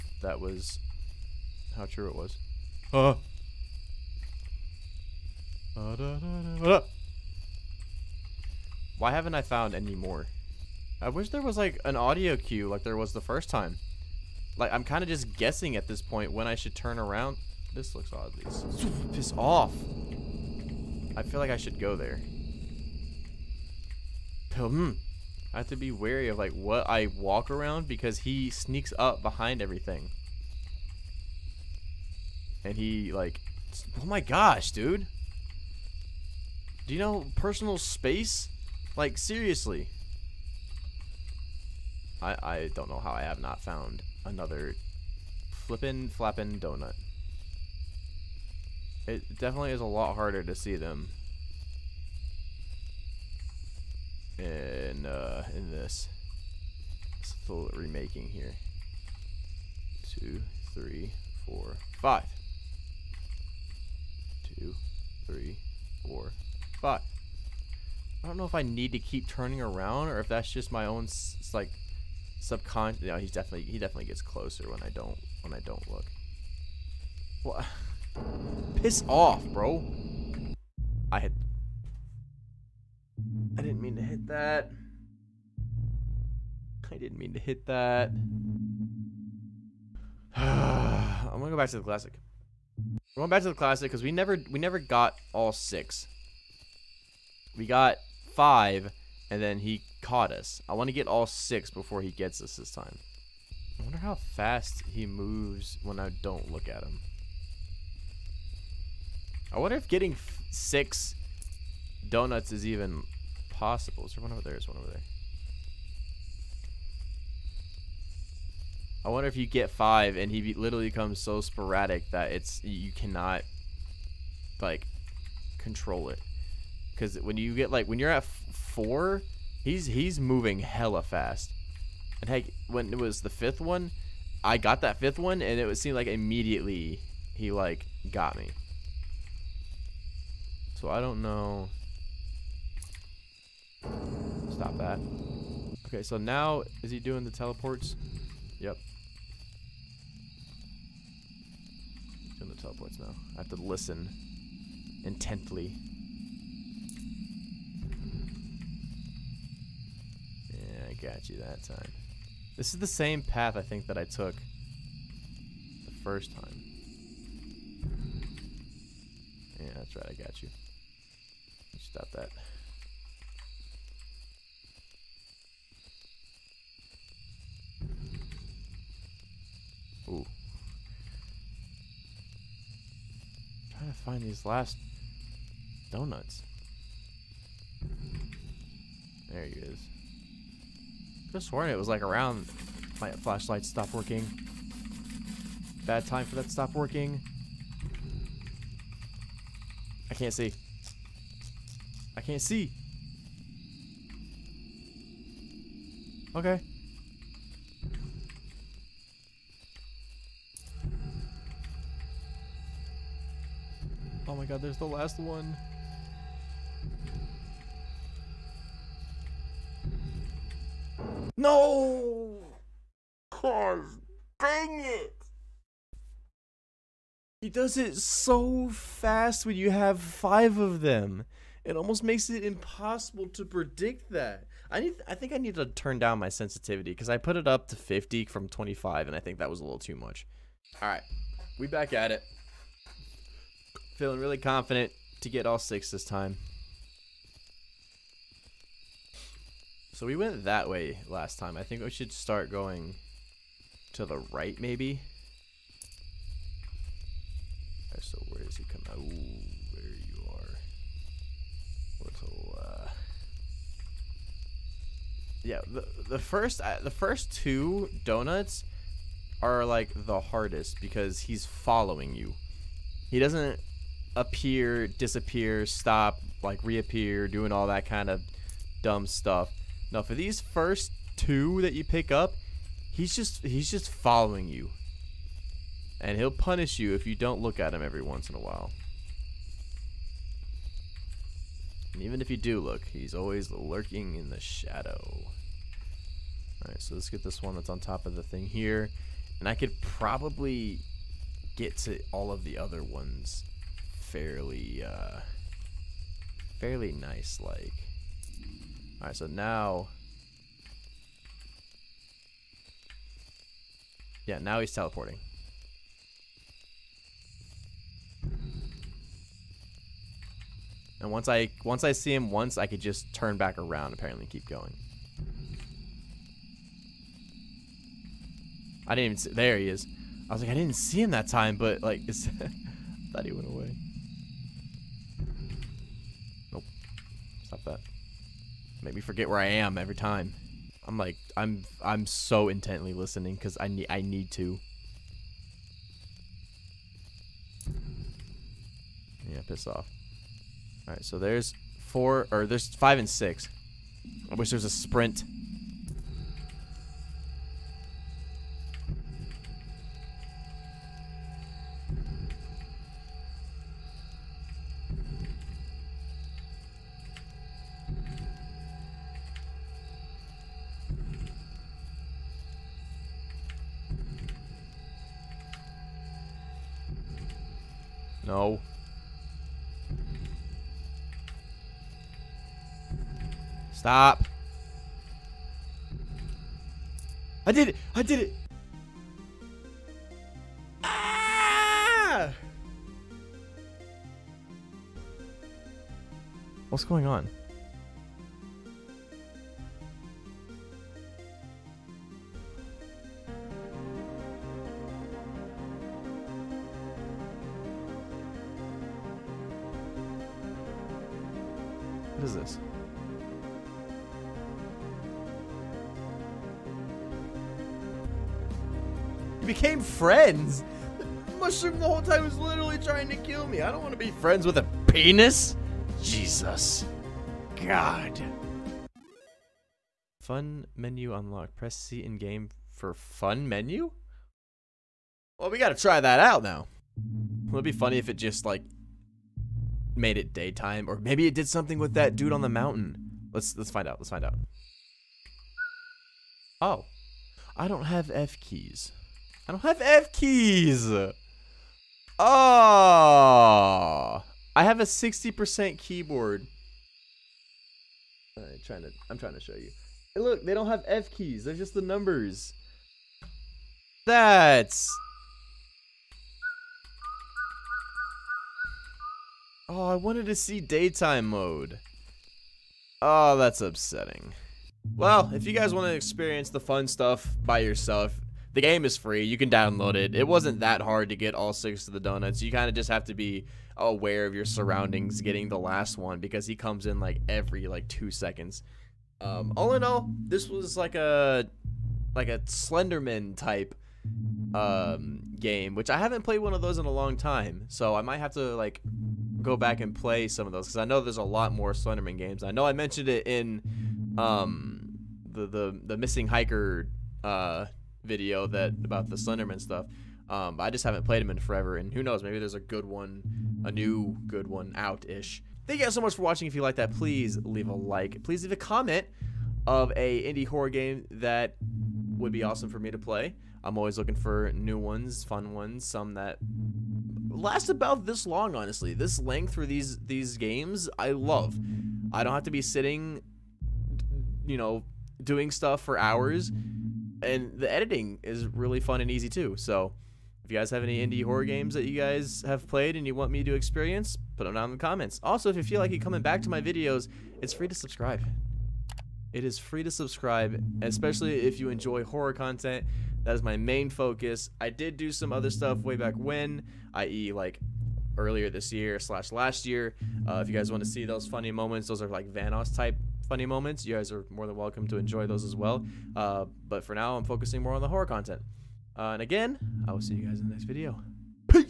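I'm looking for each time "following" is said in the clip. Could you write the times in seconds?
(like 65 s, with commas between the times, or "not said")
271 s, 283 s.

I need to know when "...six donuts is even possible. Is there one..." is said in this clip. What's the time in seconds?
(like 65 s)
110 s.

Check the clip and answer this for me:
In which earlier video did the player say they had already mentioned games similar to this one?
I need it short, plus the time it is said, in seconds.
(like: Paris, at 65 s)
The Missing Hiker, at 505 s.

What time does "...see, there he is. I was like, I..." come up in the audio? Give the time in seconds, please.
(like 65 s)
329 s.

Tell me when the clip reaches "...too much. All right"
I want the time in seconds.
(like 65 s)
239 s.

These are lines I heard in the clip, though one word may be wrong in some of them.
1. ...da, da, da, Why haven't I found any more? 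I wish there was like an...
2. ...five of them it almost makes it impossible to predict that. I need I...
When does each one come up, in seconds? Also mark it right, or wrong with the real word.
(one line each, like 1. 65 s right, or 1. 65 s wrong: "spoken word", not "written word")
1. 5 s right
2. 229 s right.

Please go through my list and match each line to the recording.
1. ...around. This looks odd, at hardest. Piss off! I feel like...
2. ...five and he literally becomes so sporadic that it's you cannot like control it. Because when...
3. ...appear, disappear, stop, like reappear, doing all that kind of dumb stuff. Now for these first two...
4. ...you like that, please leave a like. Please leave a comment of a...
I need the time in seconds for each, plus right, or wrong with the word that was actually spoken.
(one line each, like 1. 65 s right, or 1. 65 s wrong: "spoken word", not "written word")
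1. 16 s wrong: "least", not "hardest"
2. 119 s right
3. 274 s right
4. 516 s right.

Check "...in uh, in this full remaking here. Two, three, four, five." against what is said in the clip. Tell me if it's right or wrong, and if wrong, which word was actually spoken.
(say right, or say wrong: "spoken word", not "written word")
right.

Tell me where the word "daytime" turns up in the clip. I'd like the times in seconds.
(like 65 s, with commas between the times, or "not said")
440 s, 470 s.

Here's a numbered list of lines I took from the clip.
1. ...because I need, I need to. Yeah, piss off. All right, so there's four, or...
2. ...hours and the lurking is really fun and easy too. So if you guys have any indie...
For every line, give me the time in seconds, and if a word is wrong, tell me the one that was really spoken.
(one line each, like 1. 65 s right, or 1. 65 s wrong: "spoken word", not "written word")
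1. 343 s right
2. 535 s wrong: "editing", not "lurking".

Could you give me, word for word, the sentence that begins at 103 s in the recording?
I wonder how fast he moves when I don't look at him.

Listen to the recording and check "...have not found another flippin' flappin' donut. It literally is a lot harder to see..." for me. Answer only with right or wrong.
wrong.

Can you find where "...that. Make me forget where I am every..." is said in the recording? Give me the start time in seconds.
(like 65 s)
337 s.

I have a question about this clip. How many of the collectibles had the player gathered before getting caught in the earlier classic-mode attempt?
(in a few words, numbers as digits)
5.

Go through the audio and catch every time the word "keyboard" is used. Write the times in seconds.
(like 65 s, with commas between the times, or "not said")
455 s.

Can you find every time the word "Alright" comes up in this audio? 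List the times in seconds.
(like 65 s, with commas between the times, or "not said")
296 s, 308 s.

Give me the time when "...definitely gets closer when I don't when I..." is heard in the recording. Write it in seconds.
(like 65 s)
73 s.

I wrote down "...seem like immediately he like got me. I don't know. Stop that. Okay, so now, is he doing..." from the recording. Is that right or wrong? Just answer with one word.
right.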